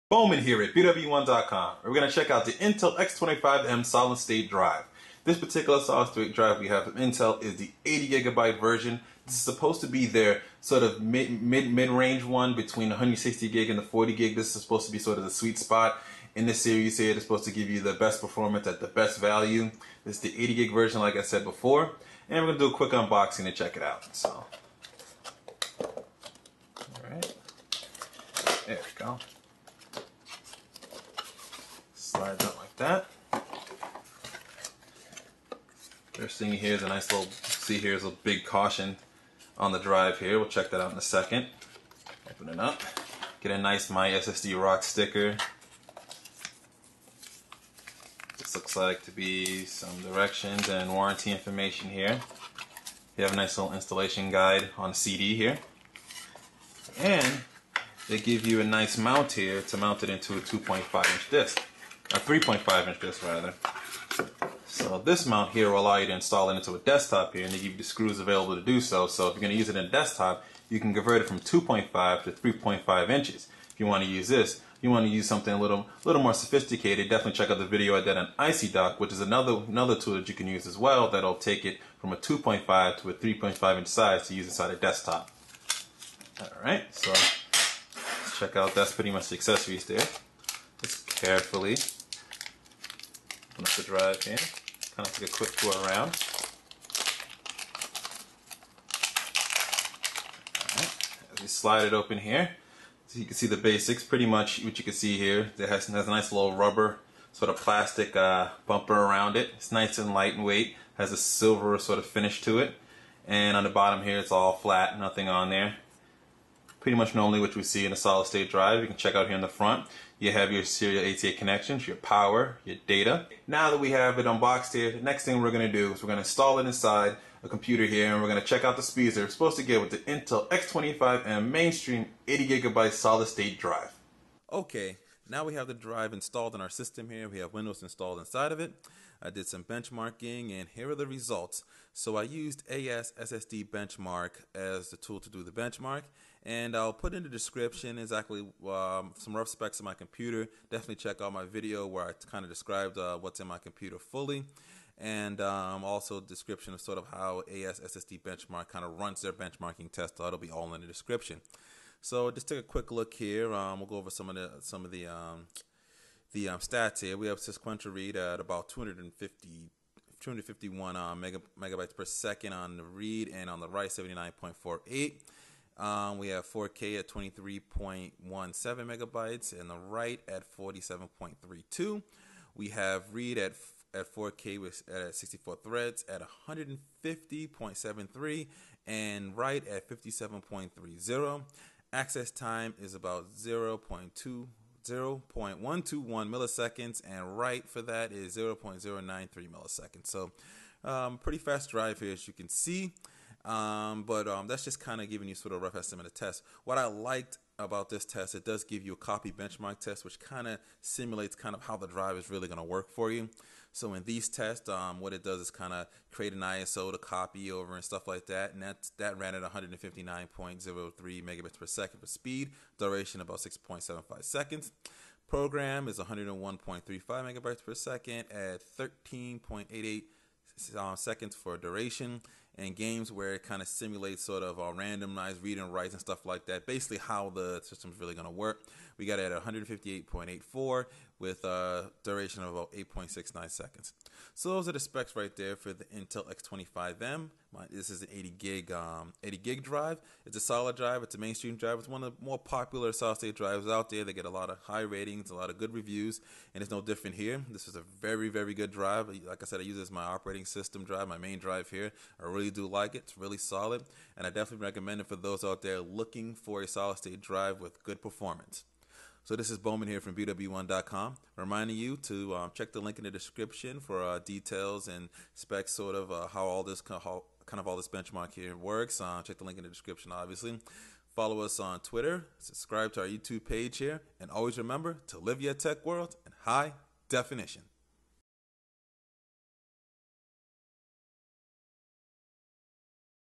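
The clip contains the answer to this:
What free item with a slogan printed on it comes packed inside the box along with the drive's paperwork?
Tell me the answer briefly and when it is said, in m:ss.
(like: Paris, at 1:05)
My SSD Rock sticker, at 0:43.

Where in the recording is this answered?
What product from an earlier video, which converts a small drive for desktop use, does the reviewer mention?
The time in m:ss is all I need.
1:18.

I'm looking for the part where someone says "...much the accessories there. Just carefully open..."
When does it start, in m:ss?
1:29.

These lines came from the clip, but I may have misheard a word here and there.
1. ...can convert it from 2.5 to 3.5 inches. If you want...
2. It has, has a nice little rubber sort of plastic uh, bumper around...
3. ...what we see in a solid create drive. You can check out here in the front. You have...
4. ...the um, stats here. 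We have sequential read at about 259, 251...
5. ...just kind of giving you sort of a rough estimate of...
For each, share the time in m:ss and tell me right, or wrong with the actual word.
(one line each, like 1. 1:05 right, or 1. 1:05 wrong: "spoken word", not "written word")
1. 1:10 right
2. 1:45 right
3. 1:57 wrong: "state", not "create"
4. 2:46 wrong: "250", not "259"
5. 3:24 right.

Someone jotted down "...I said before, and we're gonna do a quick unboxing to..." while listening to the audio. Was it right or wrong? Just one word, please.
right.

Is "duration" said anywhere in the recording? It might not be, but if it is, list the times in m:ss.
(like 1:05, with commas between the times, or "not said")
3:42, 3:51, 4:02.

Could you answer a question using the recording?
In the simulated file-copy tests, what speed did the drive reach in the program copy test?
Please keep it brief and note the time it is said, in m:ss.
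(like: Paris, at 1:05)
101.35 MB/s, at 3:45.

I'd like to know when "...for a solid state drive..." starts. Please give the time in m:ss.
4:26.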